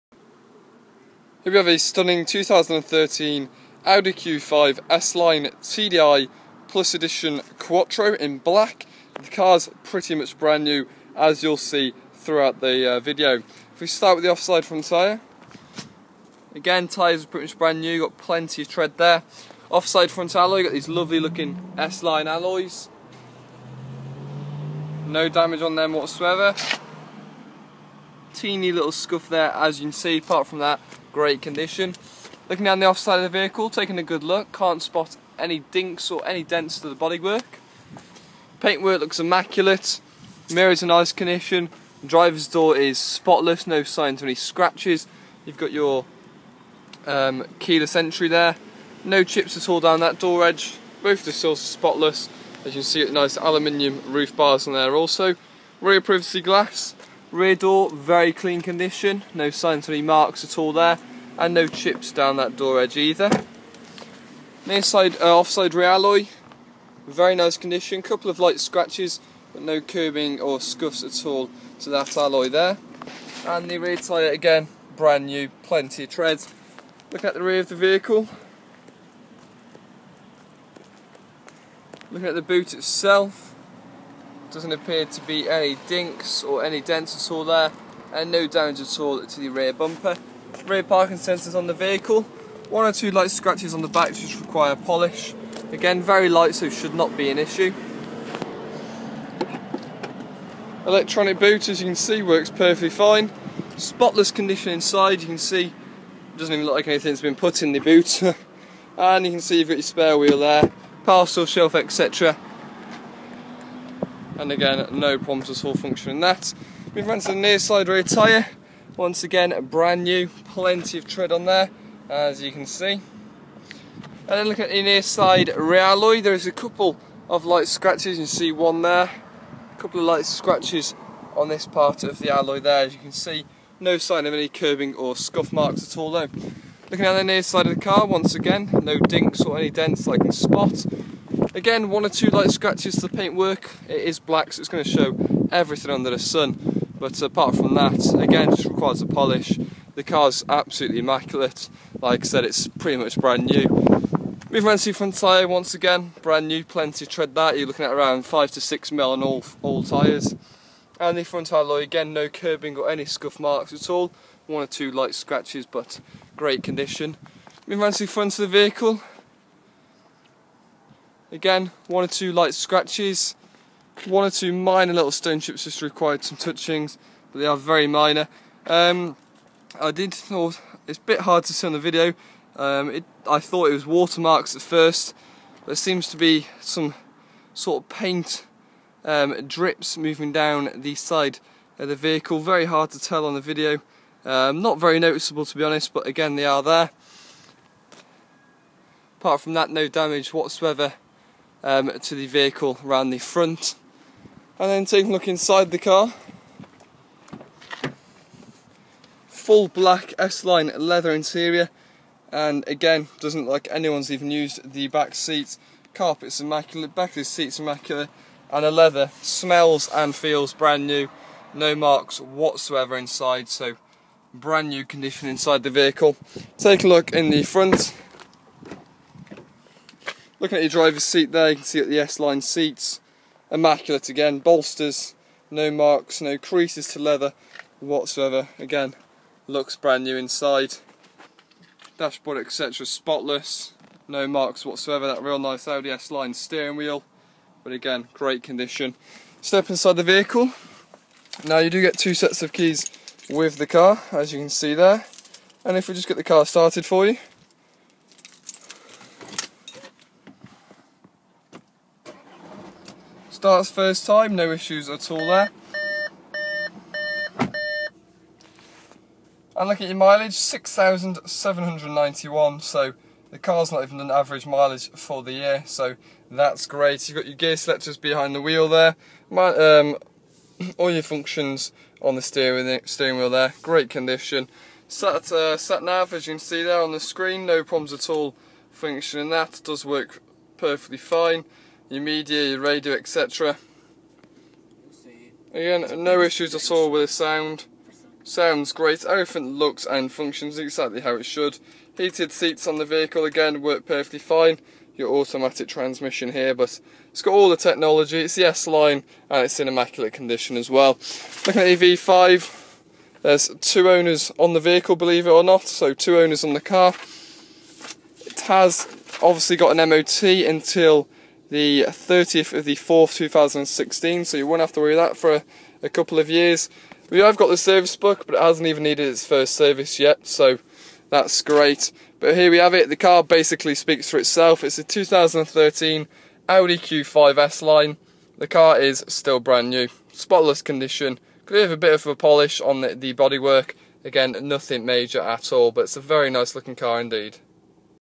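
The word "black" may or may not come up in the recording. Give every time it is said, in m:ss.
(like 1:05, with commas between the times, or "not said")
0:08, 2:24, 3:29.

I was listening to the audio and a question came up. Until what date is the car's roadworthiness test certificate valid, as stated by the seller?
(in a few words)
30/04/2016.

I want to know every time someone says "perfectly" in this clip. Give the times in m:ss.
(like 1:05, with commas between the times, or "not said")
1:42, 4:50, 5:03.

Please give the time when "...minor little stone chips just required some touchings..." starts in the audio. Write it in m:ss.
2:54.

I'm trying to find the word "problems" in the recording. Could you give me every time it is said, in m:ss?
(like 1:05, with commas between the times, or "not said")
1:55, 4:47.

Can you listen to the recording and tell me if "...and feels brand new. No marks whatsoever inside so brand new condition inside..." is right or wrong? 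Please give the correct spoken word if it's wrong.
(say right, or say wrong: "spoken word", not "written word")
right.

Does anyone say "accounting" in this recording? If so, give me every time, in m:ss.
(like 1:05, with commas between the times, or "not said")
not said.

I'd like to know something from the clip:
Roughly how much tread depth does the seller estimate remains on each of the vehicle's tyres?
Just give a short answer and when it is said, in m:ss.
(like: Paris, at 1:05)
5 to 6 mm, at 2:38.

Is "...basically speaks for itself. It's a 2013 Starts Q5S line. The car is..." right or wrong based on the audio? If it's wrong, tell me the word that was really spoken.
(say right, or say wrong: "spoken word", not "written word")
wrong: "Audi", not "Starts".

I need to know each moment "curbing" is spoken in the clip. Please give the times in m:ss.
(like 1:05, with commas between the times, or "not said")
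1:09, 2:14, 2:42.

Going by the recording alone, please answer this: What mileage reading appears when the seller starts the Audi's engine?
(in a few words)
6,791.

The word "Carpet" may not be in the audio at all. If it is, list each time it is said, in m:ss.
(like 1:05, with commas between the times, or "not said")
3:35.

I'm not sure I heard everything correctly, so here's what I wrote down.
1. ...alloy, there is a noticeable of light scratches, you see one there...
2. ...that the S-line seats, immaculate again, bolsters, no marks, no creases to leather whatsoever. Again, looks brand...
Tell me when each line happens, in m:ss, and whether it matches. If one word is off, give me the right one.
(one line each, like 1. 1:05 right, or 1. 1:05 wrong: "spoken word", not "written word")
1. 2:05 wrong: "couple", not "noticeable"
2. 3:51 right.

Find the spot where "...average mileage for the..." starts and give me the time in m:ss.
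4:34.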